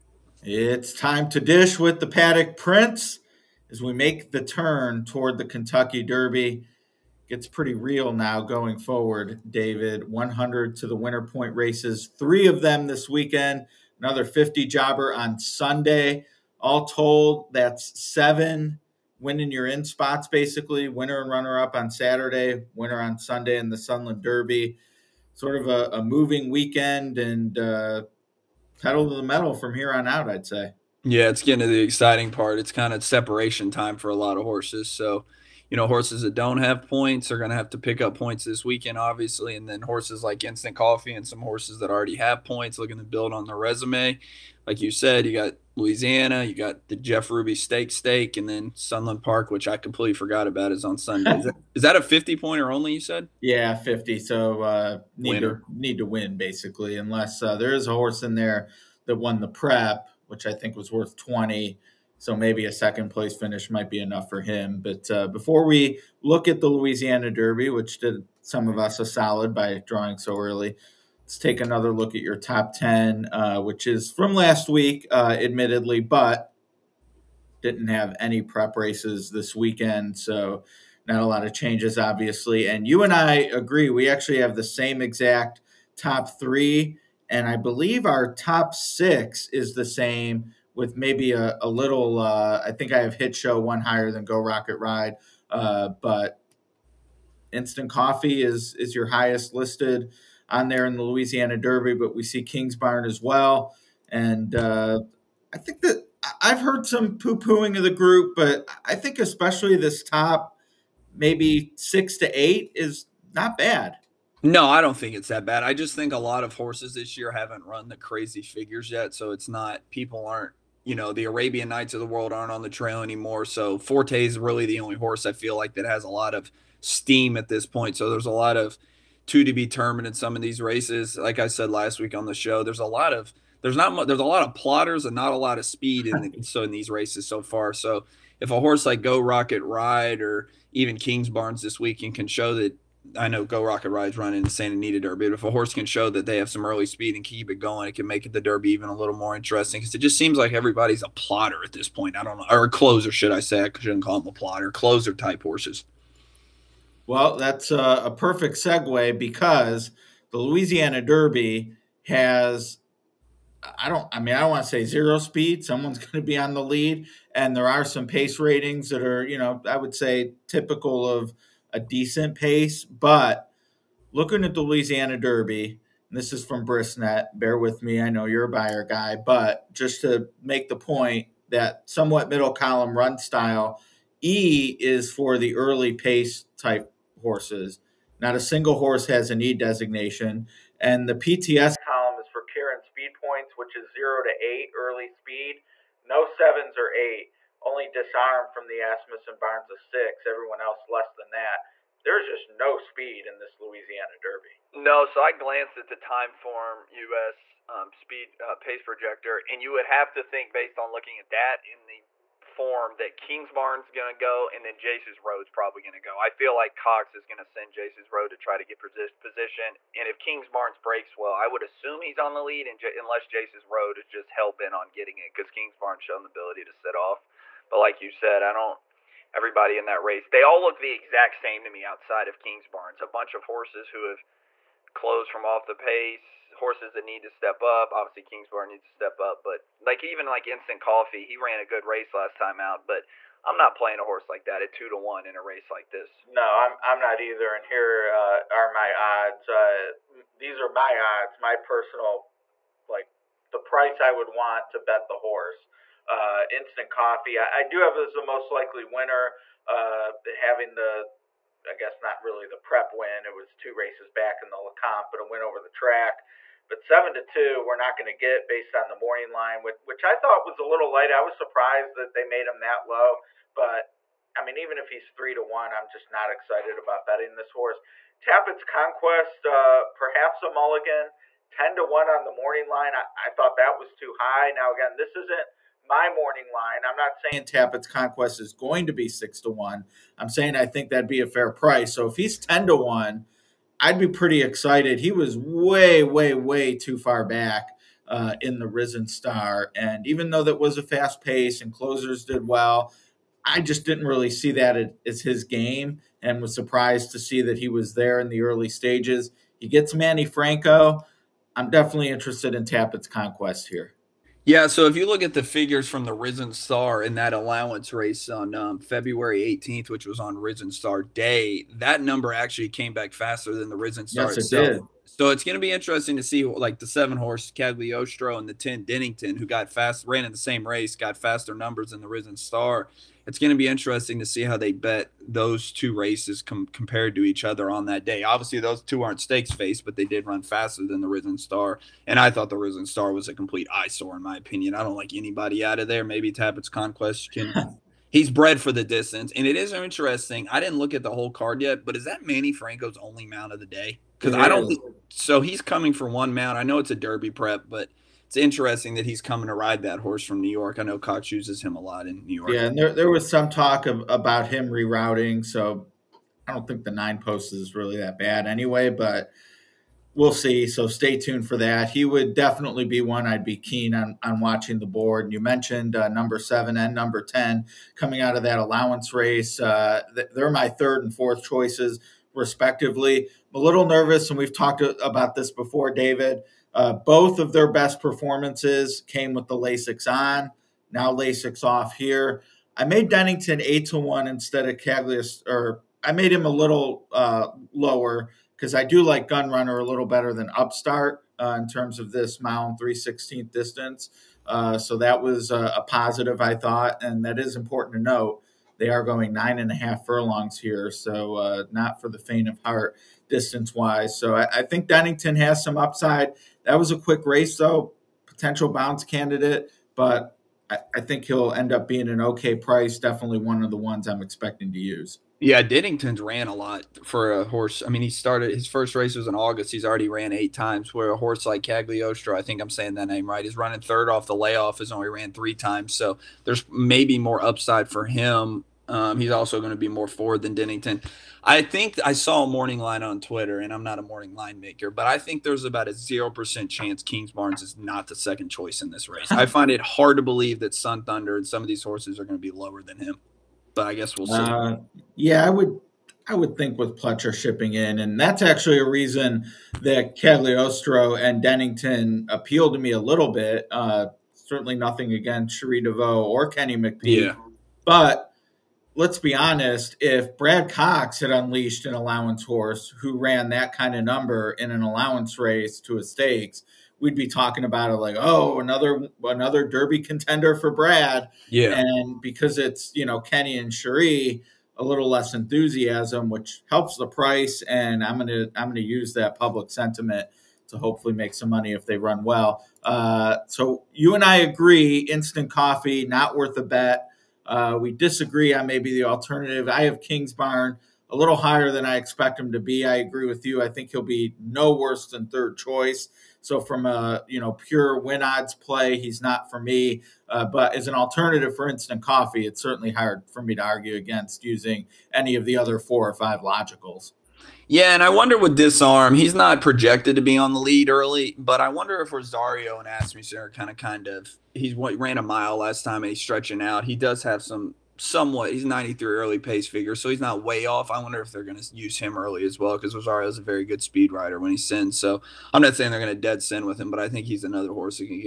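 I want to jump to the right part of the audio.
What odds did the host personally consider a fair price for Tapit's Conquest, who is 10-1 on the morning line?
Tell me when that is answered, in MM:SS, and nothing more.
04:49.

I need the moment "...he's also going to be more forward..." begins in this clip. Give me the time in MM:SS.
07:19.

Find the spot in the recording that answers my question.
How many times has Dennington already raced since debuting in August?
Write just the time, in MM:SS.
07:10.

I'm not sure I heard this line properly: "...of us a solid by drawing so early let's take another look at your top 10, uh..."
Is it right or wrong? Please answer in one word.
right.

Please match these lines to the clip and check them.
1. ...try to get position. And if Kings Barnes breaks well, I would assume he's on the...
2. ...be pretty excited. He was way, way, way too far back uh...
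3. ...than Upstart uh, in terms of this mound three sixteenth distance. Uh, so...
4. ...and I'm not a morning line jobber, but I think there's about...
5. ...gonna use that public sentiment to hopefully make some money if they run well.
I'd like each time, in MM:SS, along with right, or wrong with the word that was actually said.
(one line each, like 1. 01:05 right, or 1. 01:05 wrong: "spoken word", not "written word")
1. 03:38 right
2. 04:53 right
3. 06:40 right
4. 07:23 wrong: "maker", not "jobber"
5. 08:08 right.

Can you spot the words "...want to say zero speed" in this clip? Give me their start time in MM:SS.
02:44.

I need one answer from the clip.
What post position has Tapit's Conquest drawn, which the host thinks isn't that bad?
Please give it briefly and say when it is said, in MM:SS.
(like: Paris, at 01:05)
9, at 06:06.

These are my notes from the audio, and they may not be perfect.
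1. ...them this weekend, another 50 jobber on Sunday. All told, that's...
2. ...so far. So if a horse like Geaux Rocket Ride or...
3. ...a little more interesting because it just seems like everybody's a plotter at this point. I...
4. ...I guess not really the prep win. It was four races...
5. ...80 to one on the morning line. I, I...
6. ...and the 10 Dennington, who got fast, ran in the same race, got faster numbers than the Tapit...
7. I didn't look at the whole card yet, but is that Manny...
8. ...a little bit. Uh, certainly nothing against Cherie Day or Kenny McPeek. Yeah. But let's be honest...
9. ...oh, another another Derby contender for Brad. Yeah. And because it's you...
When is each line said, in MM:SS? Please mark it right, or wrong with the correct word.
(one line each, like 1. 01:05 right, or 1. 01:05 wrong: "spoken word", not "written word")
1. 00:12 right
2. 02:17 right
3. 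02:28 right
4. 04:21 wrong: "two", not "four"
5. 04:41 wrong: "10", not "80"
6. 05:28 wrong: "Risen", not "Tapit"
7. 05:50 right
8. 07:42 wrong: "DeVaux", not "Day"
9. 07:58 right.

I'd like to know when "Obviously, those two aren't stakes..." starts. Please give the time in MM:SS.
05:38.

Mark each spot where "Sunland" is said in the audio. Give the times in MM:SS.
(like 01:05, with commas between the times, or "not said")
00:23, 00:48.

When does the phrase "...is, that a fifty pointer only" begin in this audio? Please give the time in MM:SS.
00:51.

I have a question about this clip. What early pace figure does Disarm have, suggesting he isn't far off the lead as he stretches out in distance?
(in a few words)
93.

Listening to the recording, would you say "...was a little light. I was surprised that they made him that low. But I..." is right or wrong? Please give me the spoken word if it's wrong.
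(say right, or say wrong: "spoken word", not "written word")
right.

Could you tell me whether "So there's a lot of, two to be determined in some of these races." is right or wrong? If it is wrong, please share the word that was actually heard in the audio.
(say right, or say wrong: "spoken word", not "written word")
right.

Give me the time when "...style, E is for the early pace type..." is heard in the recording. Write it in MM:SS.
03:03.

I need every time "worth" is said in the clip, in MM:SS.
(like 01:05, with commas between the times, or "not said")
01:00, 08:16.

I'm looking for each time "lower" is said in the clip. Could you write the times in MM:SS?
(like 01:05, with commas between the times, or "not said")
06:37, 07:32.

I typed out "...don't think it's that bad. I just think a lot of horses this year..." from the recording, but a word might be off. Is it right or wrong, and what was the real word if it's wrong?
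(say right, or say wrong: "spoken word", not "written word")
right.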